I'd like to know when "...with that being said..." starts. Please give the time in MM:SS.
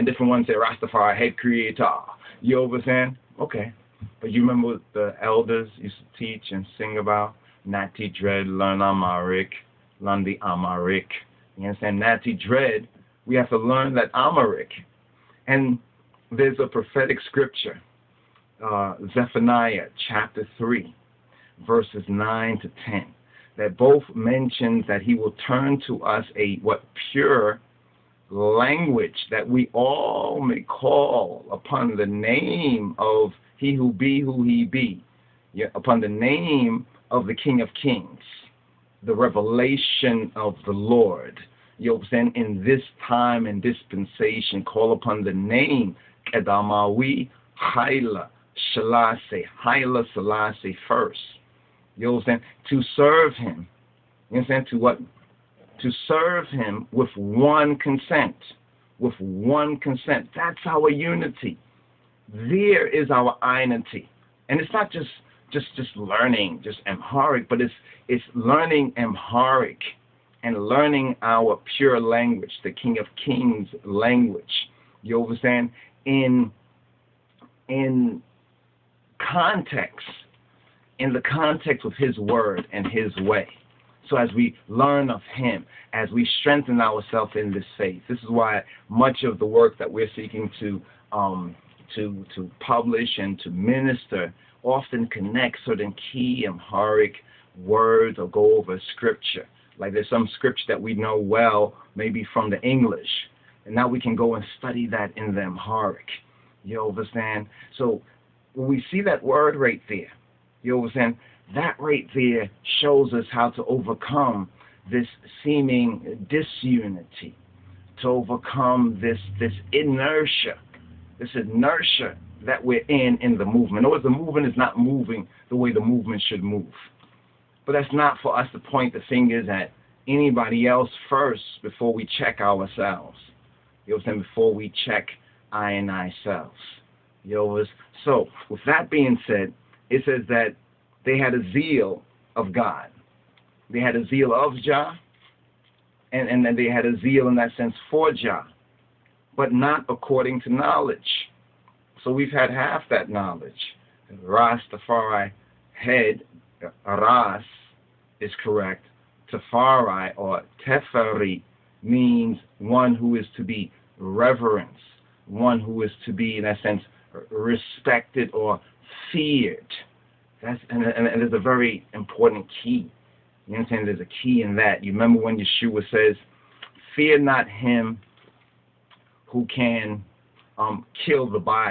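02:18.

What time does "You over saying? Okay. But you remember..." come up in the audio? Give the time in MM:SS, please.
00:02.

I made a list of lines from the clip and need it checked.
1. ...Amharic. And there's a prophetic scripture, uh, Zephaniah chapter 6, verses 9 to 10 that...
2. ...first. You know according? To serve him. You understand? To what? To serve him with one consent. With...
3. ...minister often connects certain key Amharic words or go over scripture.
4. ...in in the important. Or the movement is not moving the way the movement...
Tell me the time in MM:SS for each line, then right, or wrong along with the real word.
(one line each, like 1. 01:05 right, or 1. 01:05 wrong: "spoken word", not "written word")
1. 00:14 wrong: "3", not "6"
2. 00:50 wrong: "saying", not "according"
3. 01:33 right
4. 02:02 wrong: "movement", not "important".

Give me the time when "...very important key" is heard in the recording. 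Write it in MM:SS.
02:51.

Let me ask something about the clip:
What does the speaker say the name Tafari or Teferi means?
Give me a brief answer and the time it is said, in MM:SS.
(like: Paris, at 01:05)
One who is to be reverenced, at 02:42.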